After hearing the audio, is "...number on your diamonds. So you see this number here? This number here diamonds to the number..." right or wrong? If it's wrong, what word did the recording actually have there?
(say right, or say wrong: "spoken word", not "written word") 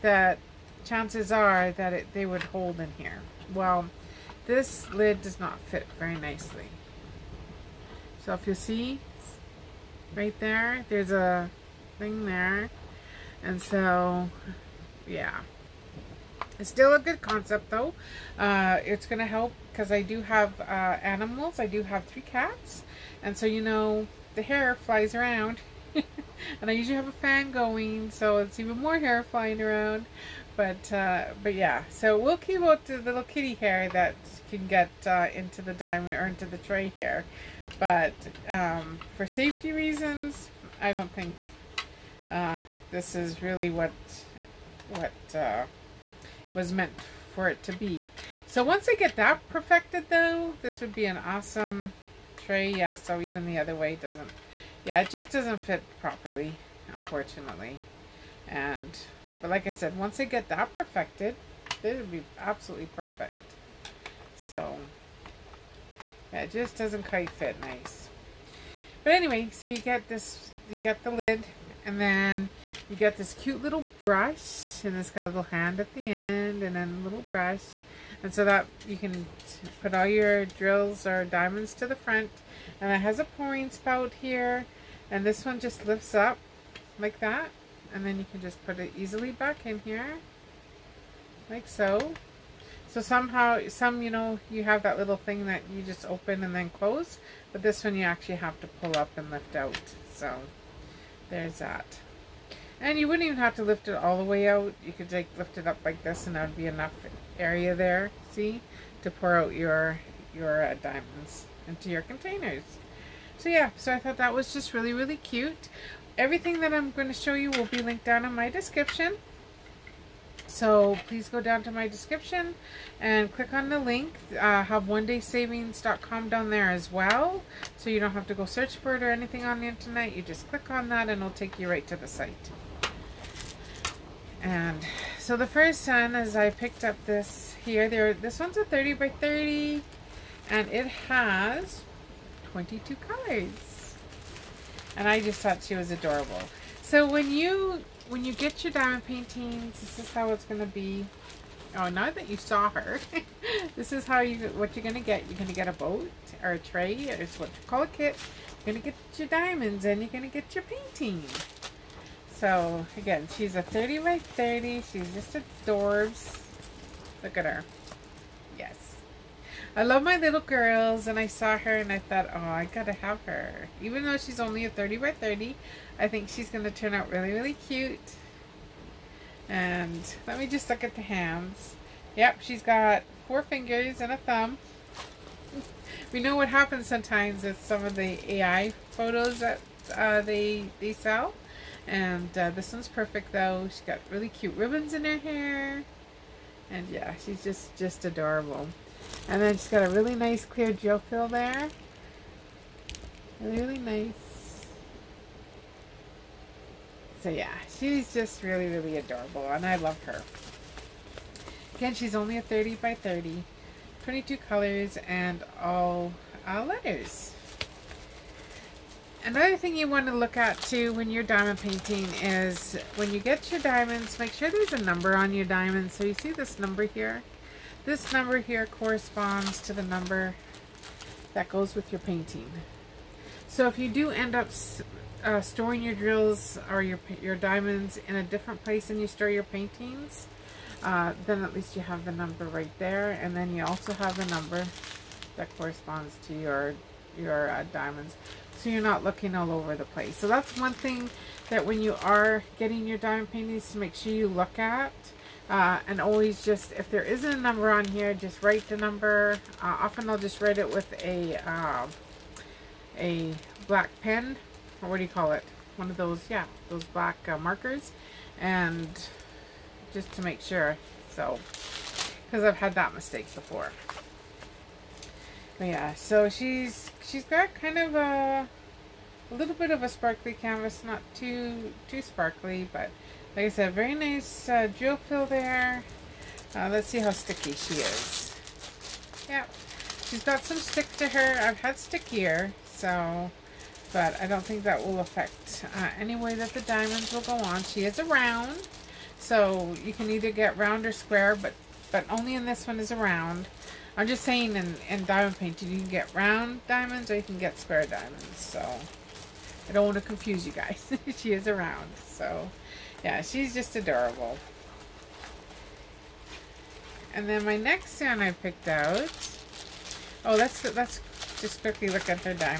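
wrong: "corresponds", not "diamonds".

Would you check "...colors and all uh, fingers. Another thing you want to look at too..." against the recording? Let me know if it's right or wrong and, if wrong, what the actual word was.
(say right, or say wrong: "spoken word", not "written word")
wrong: "letters", not "fingers".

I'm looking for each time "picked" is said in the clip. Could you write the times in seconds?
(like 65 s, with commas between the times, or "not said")
136 s, 318 s.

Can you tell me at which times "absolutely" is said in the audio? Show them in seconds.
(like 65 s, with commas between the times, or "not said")
62 s.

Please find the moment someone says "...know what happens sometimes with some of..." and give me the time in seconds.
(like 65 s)
186 s.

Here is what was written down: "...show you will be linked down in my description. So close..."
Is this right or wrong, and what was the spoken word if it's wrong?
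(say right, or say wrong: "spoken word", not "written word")
wrong: "please", not "close".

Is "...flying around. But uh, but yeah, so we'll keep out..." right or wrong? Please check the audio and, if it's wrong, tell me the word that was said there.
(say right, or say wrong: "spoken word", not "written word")
right.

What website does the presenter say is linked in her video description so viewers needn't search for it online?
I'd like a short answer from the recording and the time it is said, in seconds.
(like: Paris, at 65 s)
onedaysavings.com, at 124 s.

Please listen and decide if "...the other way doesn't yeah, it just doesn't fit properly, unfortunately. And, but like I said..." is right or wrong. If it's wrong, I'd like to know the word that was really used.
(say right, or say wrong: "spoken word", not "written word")
right.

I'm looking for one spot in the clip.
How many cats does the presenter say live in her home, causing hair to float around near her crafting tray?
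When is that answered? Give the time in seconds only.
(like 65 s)
22 s.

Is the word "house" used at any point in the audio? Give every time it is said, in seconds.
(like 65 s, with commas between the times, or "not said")
not said.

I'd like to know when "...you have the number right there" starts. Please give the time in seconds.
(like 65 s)
241 s.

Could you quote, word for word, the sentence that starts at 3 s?
Well, this lid does not fit very nicely.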